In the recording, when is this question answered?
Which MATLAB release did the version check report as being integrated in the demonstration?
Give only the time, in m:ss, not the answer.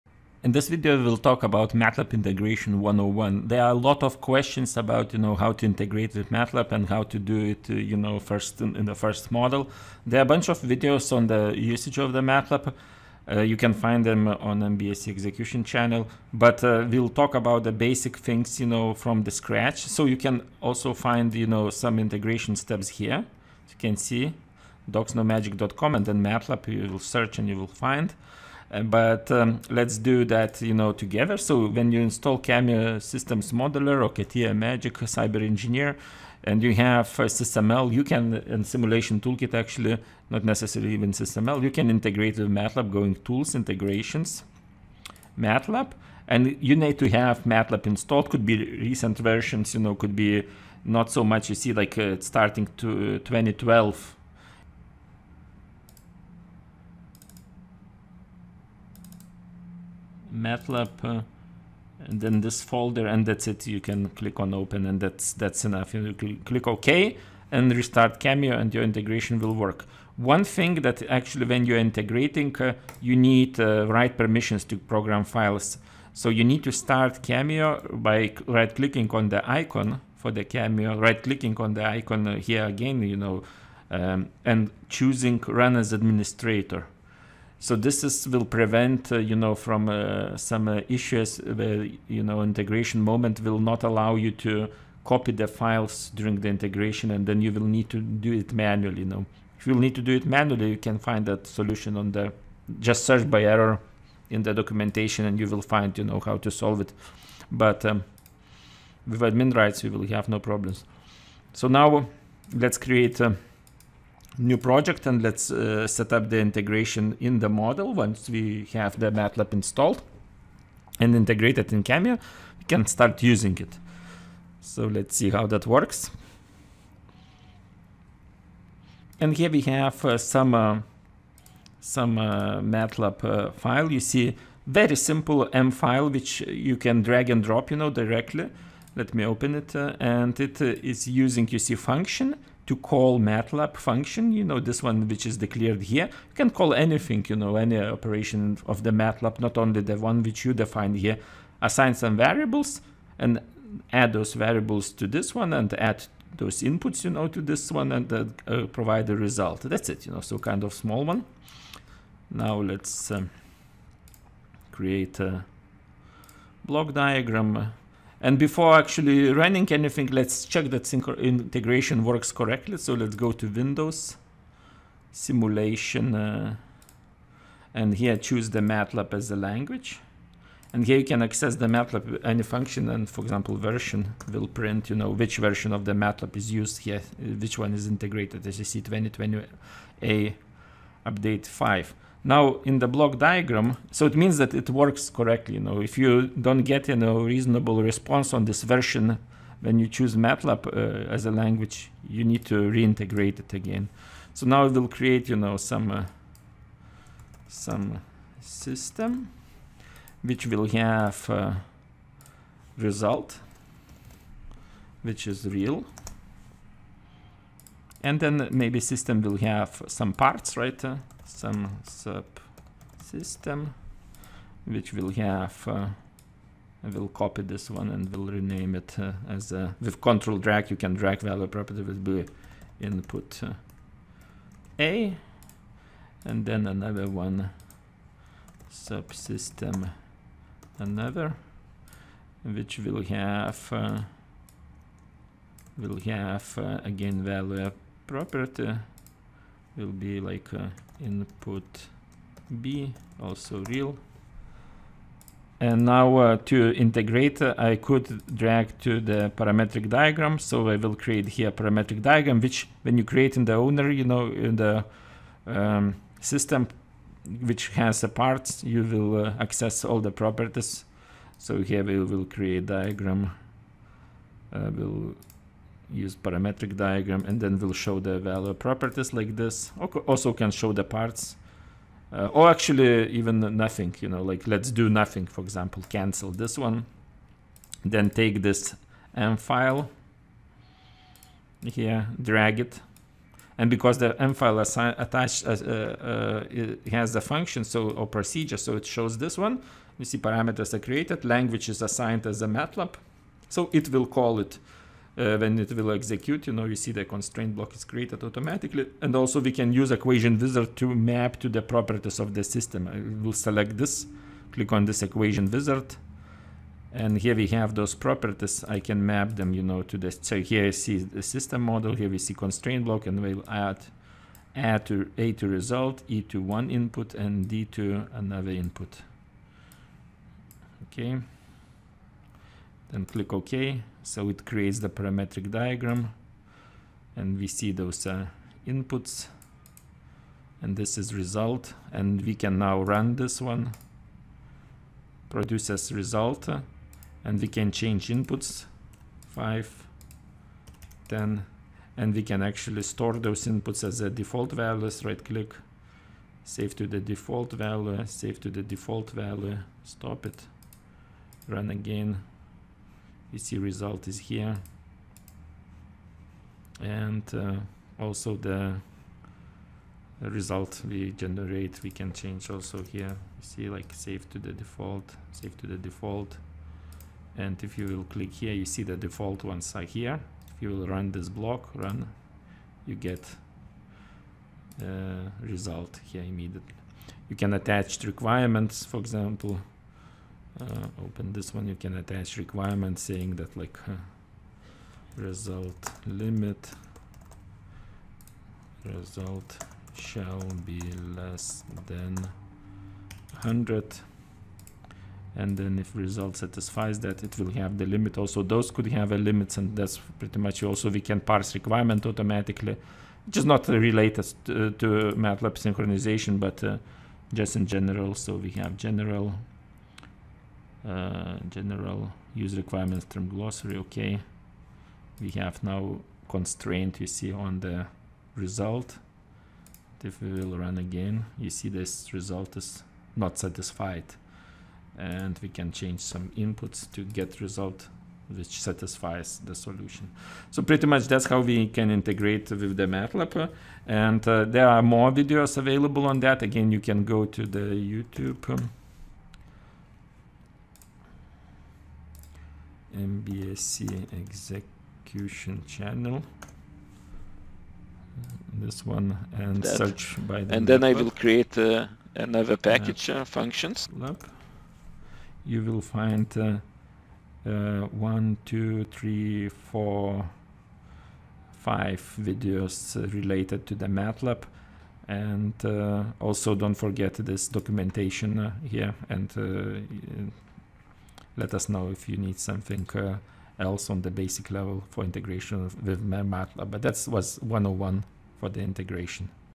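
3:08.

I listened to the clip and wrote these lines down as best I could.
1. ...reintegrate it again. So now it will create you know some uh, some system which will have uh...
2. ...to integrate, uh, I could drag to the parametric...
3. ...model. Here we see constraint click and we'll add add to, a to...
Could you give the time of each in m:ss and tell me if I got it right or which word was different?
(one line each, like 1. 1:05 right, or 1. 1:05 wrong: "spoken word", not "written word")
1. 3:22 right
2. 4:16 right
3. 5:21 wrong: "block", not "click".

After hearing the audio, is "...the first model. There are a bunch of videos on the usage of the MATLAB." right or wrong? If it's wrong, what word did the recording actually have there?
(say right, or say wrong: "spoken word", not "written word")
right.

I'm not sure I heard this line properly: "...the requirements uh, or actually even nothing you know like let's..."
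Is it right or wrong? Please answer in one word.
wrong.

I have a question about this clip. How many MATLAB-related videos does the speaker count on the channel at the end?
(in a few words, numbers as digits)
5.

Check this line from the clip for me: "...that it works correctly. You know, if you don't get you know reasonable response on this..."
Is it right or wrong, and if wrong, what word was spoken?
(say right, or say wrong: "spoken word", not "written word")
right.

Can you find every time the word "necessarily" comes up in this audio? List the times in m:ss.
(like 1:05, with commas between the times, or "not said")
0:40.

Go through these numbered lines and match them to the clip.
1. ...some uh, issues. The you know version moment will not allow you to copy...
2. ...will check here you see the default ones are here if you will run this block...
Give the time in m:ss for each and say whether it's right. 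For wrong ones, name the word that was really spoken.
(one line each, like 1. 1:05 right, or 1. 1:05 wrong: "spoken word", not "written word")
1. 1:30 wrong: "integration", not "version"
2. 6:17 wrong: "click", not "check".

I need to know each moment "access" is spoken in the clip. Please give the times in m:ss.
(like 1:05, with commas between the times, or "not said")
3:01, 4:29.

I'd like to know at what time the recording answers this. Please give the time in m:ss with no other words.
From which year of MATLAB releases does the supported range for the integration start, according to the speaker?
0:53.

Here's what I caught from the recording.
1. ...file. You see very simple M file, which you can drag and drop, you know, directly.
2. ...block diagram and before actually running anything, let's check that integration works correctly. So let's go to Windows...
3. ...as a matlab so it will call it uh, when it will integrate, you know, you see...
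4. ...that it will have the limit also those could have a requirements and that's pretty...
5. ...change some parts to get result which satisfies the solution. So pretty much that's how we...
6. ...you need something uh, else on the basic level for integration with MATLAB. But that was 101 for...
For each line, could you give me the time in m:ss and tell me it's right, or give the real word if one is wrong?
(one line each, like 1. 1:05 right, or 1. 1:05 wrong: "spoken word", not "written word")
1. 2:13 right
2. 2:46 right
3. 5:02 wrong: "execute", not "integrate"
4. 6:46 wrong: "limits", not "requirements"
5. 7:15 wrong: "inputs", not "parts"
6. 8:02 right.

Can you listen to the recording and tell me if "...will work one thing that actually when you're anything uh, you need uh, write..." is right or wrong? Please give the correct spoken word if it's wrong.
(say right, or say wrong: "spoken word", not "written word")
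wrong: "integrating", not "anything".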